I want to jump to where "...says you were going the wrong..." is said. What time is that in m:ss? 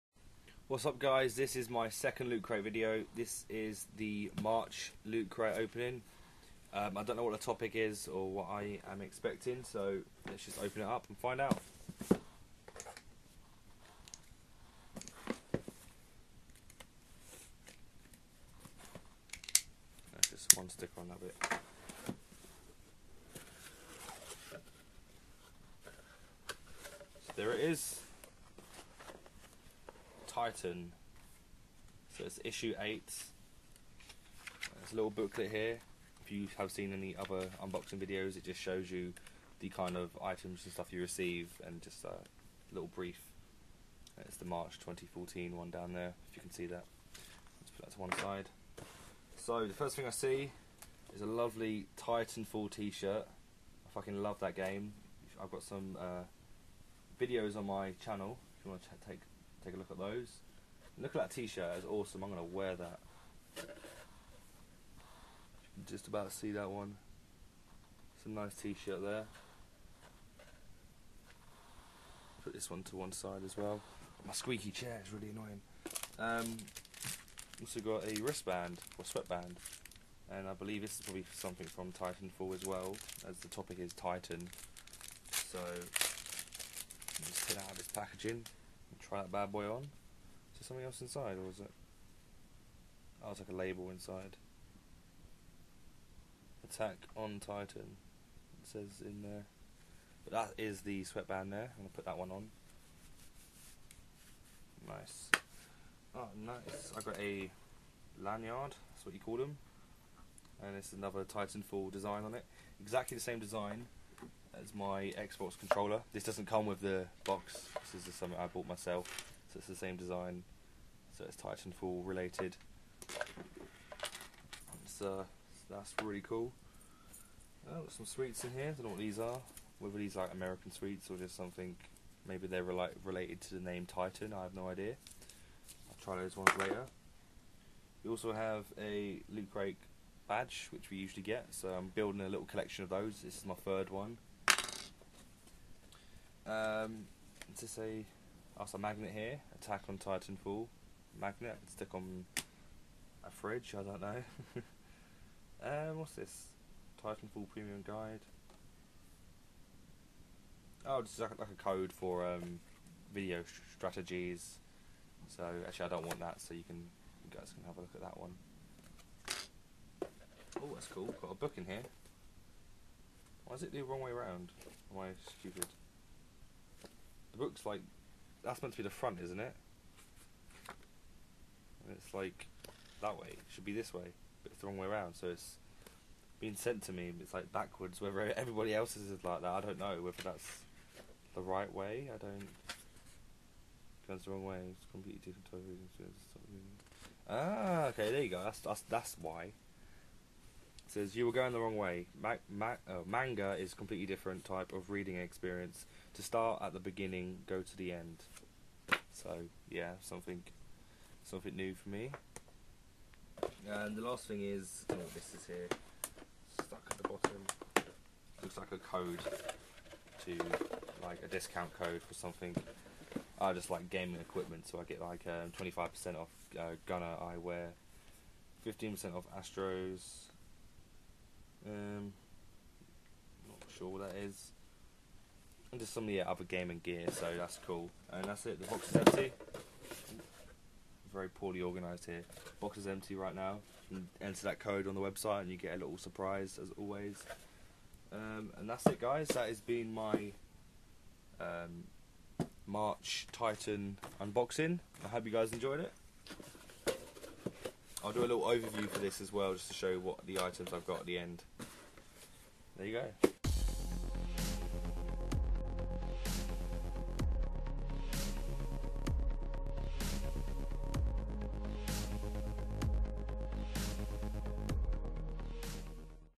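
3:20.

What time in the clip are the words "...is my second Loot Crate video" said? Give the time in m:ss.
0:01.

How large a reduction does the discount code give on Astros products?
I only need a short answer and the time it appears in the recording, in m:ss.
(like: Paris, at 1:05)
15%, at 3:48.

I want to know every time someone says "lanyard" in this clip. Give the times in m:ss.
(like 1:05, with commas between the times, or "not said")
1:48.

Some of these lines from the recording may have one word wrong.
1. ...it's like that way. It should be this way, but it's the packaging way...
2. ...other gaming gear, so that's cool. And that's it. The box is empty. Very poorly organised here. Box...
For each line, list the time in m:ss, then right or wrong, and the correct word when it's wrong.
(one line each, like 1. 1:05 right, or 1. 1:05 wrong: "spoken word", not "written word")
1. 3:01 wrong: "wrong", not "packaging"
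2. 3:56 right.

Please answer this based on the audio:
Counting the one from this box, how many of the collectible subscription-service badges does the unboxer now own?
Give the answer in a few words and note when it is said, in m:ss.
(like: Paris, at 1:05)
3, at 2:23.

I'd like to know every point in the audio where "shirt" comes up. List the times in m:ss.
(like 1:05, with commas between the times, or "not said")
0:52, 1:01, 1:08.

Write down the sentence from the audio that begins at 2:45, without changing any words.
So actually, I don't want that.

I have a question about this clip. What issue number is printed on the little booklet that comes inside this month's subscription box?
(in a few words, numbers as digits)
8.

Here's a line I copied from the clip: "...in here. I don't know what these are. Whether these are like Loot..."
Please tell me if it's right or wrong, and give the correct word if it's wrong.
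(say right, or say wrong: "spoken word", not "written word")
wrong: "American", not "Loot".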